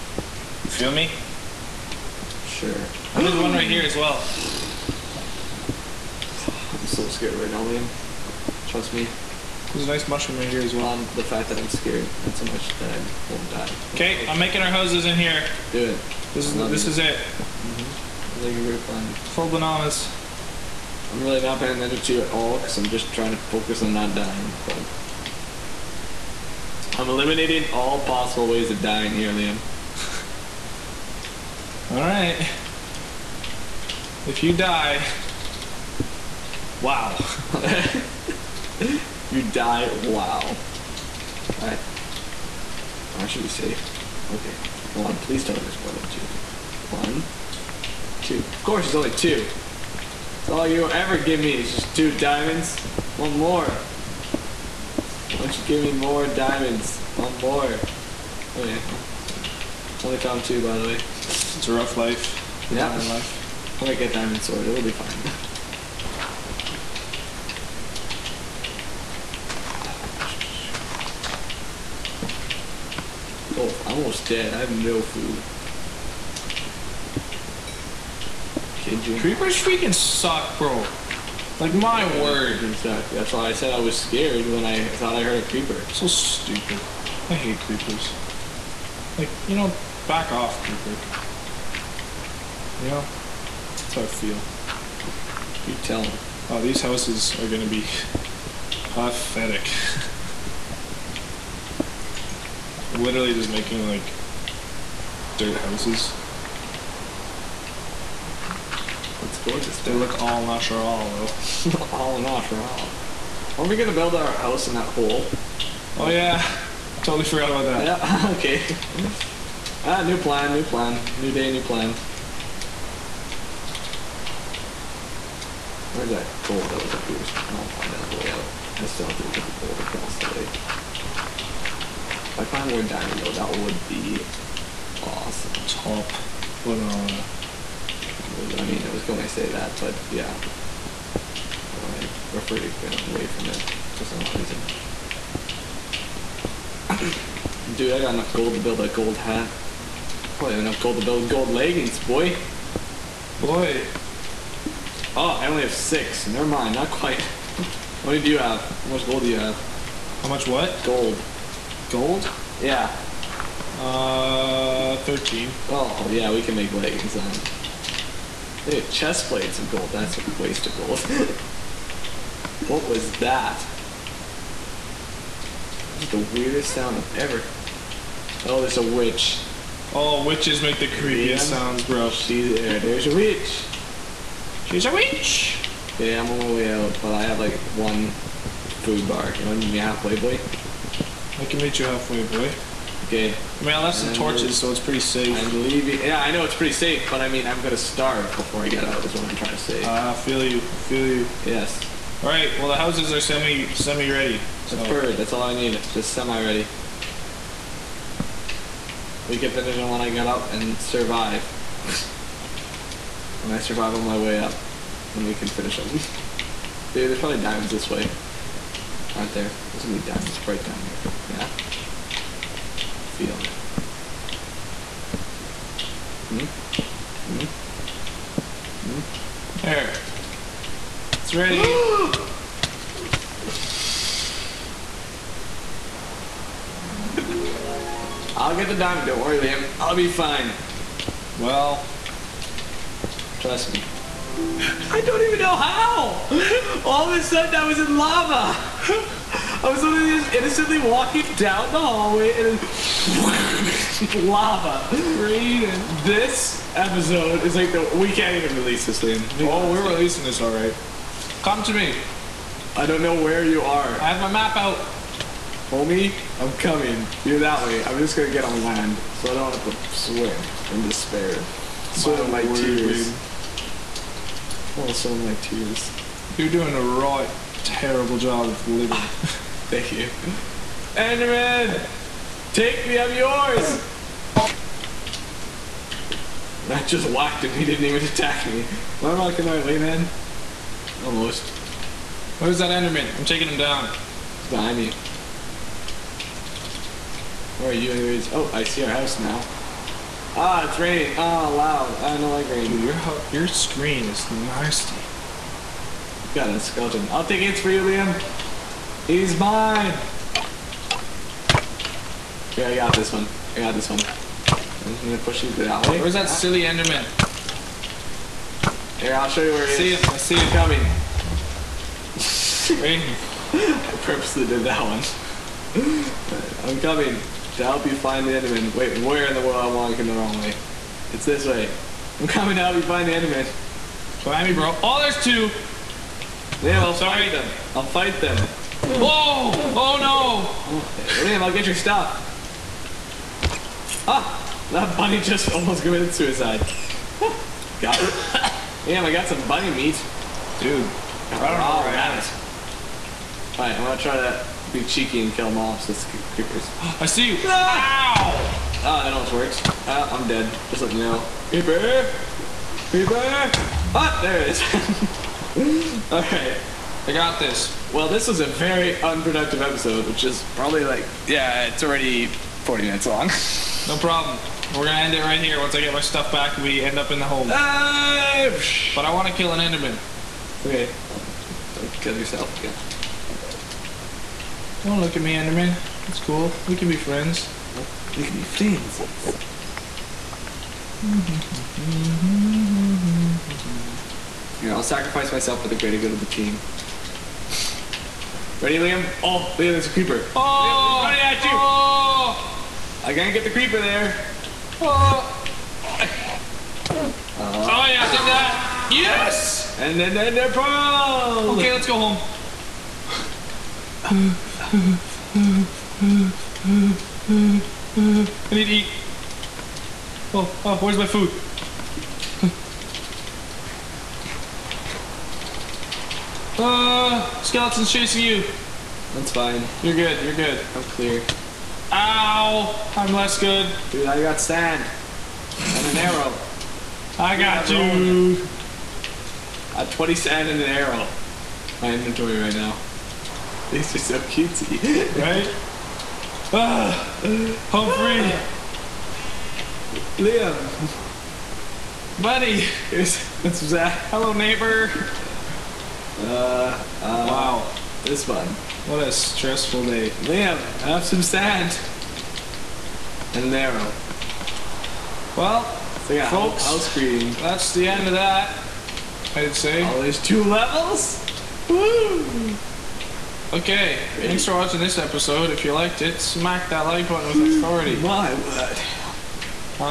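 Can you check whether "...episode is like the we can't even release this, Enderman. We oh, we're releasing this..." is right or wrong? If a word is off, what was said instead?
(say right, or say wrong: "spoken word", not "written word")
wrong: "Liam", not "Enderman".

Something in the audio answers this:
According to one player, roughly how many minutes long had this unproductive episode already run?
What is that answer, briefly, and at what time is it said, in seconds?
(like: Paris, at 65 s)
40 minutes, at 372 s.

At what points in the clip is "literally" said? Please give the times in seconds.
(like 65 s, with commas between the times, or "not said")
102 s, 249 s.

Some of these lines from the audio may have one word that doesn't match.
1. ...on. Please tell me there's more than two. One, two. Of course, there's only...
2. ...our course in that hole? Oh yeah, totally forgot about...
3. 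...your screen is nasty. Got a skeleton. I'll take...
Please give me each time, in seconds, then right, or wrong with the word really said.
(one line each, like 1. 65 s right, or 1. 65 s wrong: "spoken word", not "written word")
1. 45 s right
2. 114 s wrong: "house", not "course"
3. 303 s right.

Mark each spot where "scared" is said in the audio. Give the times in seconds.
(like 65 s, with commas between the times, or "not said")
7 s, 11 s, 83 s.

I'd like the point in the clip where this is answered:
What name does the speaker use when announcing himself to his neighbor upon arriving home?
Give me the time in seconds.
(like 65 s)
453 s.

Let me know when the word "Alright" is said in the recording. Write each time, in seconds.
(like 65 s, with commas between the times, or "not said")
353 s, 366 s.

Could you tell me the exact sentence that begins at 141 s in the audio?
Well, I referred away from it for some odd reason.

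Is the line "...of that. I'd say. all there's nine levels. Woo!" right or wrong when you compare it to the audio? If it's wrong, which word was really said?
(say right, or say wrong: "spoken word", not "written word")
wrong: "two", not "nine".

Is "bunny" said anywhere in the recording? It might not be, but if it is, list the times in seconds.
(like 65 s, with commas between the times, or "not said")
344 s, 349 s.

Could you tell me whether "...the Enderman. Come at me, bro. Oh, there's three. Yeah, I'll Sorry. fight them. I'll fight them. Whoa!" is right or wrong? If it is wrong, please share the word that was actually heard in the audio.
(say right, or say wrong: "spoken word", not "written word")
wrong: "two", not "three".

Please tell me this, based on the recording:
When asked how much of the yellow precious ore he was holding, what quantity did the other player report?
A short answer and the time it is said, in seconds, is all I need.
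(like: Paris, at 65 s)
13, at 164 s.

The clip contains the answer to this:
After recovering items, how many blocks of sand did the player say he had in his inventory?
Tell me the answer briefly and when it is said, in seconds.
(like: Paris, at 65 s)
20, at 439 s.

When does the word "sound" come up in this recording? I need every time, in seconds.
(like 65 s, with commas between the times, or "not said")
176 s, 181 s.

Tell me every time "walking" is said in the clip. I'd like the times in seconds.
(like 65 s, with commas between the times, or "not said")
250 s, 329 s.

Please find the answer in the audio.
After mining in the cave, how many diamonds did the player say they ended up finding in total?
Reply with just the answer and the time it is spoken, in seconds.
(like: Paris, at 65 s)
2, at 60 s.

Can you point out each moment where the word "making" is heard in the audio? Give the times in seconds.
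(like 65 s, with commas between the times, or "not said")
14 s, 103 s.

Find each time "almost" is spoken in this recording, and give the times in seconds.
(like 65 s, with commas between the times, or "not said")
73 s, 290 s, 345 s, 359 s.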